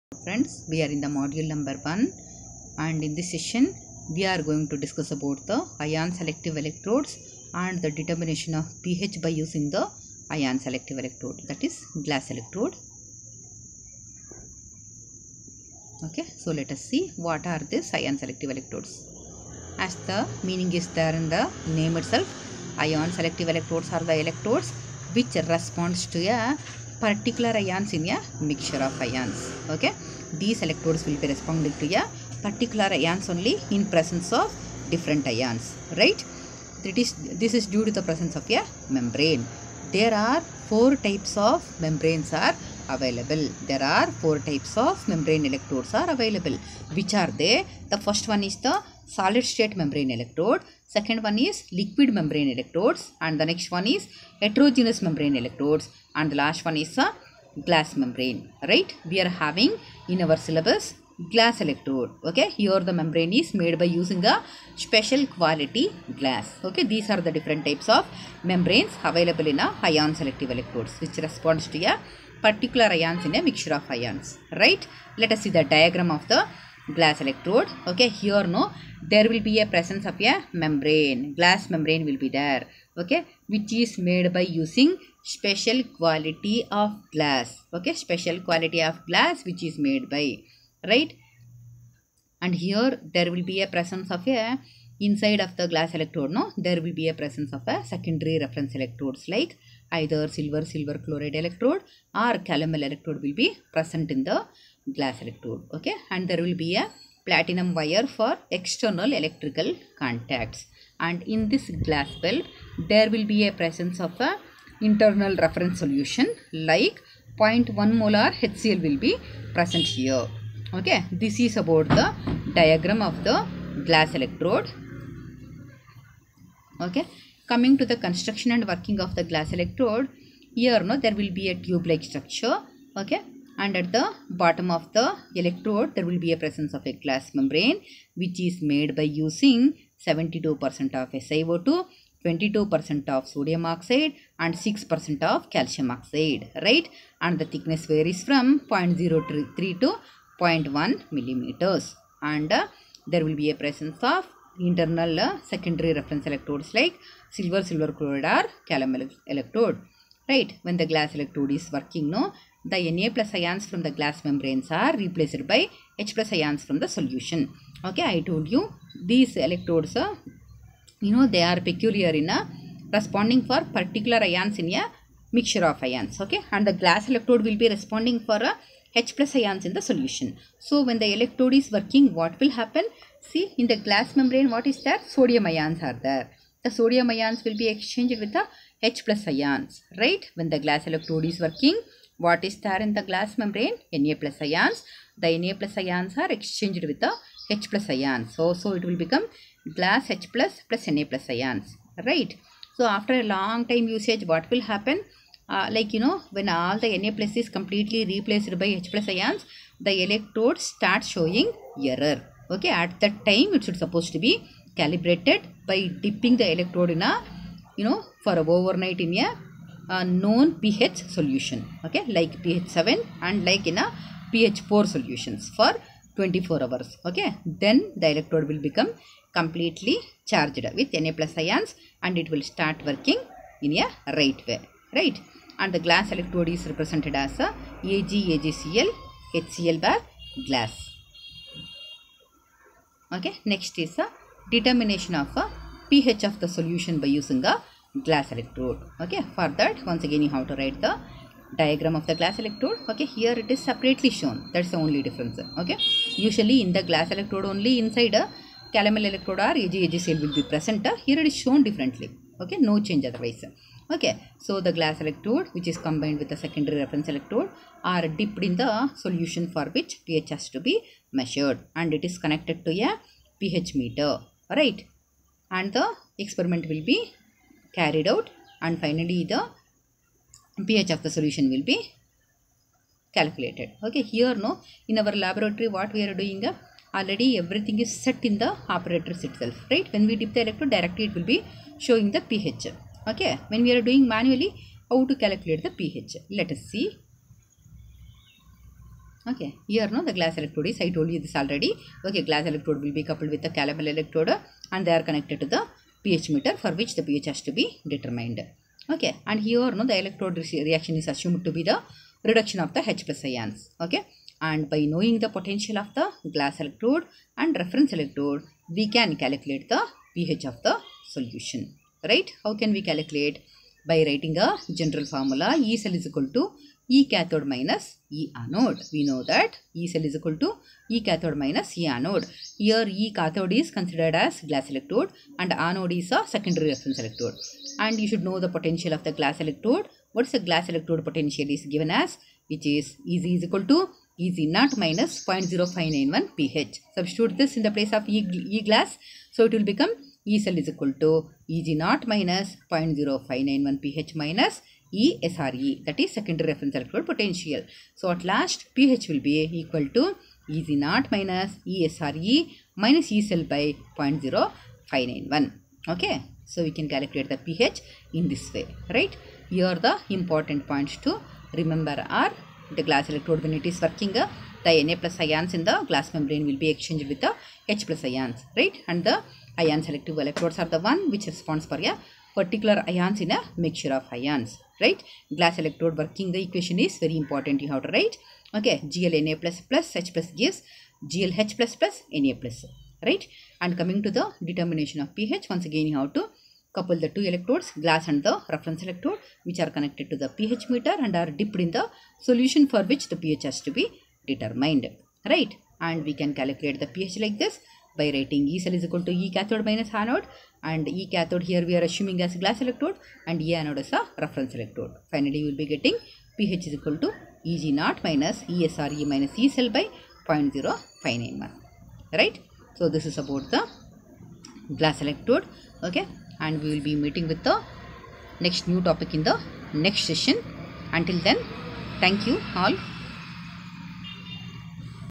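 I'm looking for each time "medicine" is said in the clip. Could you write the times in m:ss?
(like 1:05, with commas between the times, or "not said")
not said.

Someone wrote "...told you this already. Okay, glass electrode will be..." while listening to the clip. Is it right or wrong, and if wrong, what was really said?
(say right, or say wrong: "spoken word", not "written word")
right.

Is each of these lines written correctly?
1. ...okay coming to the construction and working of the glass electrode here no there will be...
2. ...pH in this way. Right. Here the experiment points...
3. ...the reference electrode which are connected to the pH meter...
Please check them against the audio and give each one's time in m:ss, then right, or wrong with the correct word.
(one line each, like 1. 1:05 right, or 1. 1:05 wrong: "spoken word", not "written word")
1. 2:06 right
2. 6:07 wrong: "important", not "experiment"
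3. 6:38 right.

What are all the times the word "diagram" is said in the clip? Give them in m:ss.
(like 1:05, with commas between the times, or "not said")
1:15, 2:02, 4:11.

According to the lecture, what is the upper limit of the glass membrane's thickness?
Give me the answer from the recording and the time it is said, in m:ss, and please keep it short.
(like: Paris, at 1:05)
0.1 millimeters, at 2:30.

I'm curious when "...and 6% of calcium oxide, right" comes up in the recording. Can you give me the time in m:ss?
2:24.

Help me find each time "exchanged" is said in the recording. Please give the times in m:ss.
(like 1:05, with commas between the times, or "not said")
3:07, 3:16, 6:16.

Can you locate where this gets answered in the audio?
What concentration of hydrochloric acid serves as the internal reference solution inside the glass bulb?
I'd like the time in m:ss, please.
1:57.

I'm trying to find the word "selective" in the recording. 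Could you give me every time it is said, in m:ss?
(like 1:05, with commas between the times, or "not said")
0:06, 0:10, 0:18, 0:23, 1:10, 6:19.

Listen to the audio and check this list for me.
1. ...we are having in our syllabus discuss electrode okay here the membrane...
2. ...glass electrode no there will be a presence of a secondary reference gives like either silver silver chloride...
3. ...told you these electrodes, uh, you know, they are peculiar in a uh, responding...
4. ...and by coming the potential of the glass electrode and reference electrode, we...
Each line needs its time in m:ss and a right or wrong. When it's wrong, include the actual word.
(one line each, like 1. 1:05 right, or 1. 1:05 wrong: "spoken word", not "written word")
1. 0:59 wrong: "glass", not "discuss"
2. 1:35 wrong: "electrodes", not "gives"
3. 2:48 right
4. 5:14 wrong: "knowing", not "coming".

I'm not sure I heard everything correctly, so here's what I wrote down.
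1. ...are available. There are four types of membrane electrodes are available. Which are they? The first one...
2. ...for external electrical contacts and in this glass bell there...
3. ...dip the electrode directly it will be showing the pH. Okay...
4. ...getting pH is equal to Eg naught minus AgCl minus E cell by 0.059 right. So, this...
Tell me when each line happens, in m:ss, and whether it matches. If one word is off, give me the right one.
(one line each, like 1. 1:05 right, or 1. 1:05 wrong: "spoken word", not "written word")
1. 0:42 right
2. 1:48 right
3. 4:50 right
4. 6:55 wrong: "ESRE", not "AgCl".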